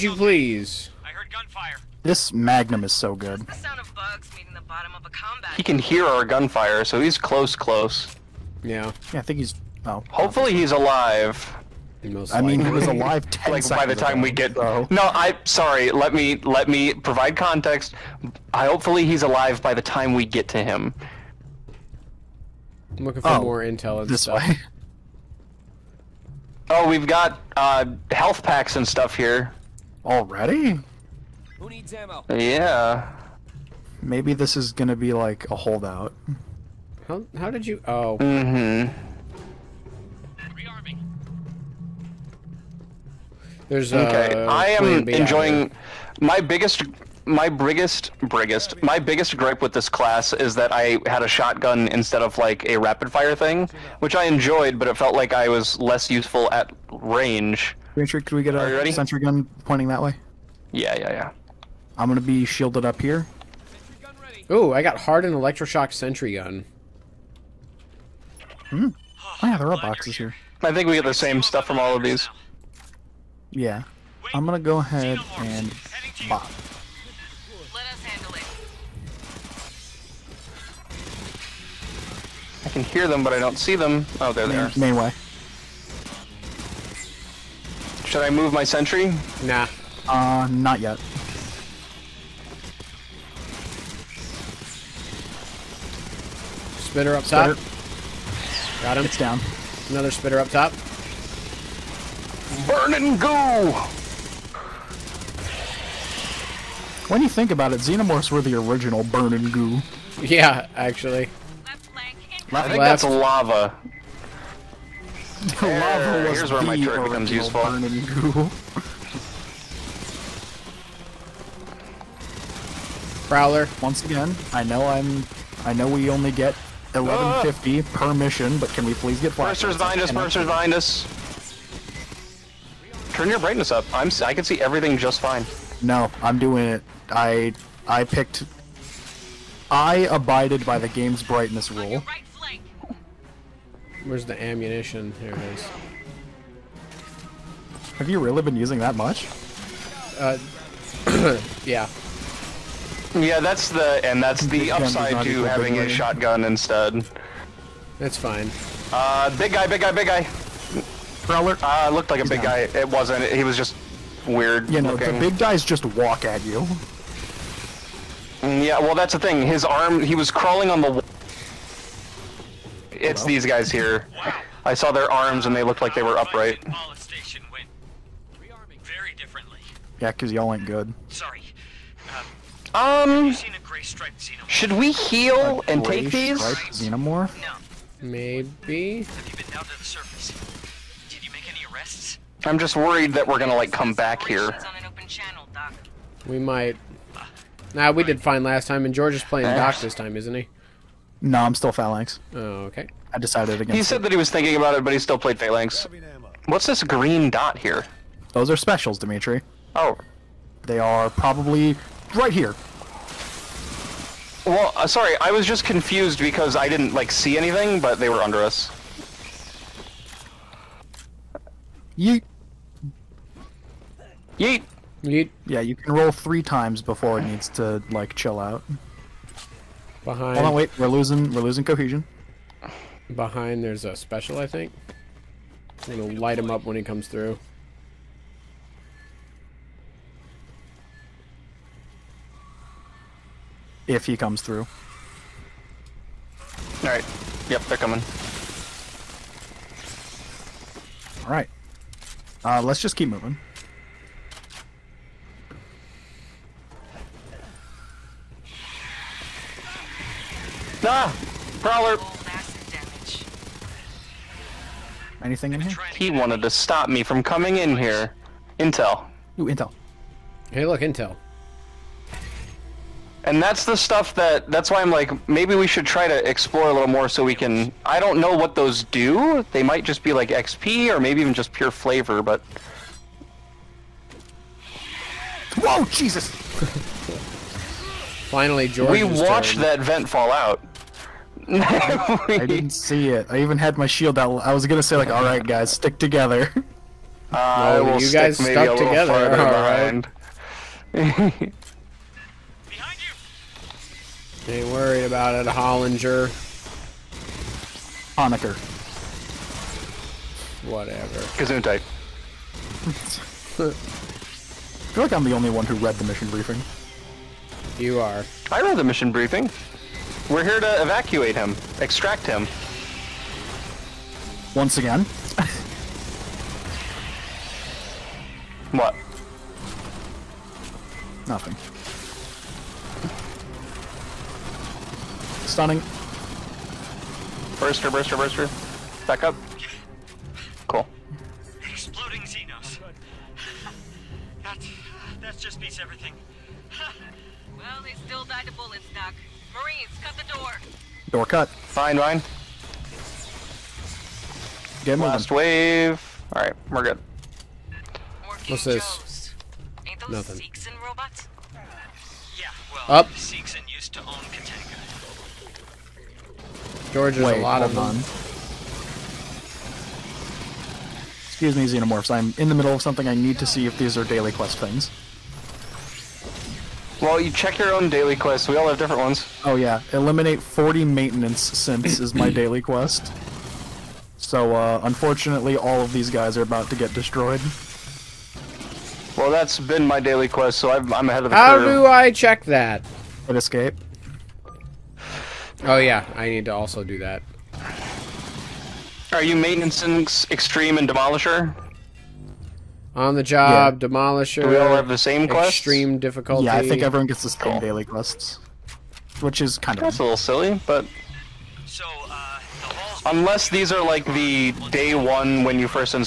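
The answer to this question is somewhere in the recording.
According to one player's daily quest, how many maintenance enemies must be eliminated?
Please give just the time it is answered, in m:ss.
6:20.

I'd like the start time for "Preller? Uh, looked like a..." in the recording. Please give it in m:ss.
2:41.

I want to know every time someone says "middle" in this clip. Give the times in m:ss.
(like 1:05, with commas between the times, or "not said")
6:12.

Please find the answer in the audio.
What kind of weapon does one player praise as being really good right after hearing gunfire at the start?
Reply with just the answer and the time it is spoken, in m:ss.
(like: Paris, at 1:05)
Magnum, at 0:02.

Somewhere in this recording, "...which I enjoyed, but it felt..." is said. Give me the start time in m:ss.
0:53.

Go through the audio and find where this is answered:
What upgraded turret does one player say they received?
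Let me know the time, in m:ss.
1:04.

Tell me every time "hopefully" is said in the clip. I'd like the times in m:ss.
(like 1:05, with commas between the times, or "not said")
0:10, 0:18.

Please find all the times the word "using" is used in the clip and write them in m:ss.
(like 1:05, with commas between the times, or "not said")
2:28.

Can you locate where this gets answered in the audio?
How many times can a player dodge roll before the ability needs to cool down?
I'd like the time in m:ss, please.
3:46.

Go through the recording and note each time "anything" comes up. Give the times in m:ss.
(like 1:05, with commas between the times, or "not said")
3:37, 4:25.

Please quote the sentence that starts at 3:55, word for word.
We're gonna light him up when he comes through.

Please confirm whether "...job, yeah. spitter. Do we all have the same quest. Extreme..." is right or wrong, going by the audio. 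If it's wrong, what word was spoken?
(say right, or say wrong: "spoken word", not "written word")
wrong: "demolisher", not "spitter".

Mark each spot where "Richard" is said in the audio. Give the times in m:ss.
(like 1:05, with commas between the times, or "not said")
0:57.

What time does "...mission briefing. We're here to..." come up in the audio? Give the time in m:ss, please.
5:18.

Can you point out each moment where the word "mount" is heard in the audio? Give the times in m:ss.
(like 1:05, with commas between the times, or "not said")
not said.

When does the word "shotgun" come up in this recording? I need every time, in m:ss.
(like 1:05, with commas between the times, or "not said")
0:51, 2:35.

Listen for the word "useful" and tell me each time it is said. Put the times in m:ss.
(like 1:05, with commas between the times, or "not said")
0:56, 1:57.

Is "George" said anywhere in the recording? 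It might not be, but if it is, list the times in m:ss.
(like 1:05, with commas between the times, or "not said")
3:18, 4:48, 6:06.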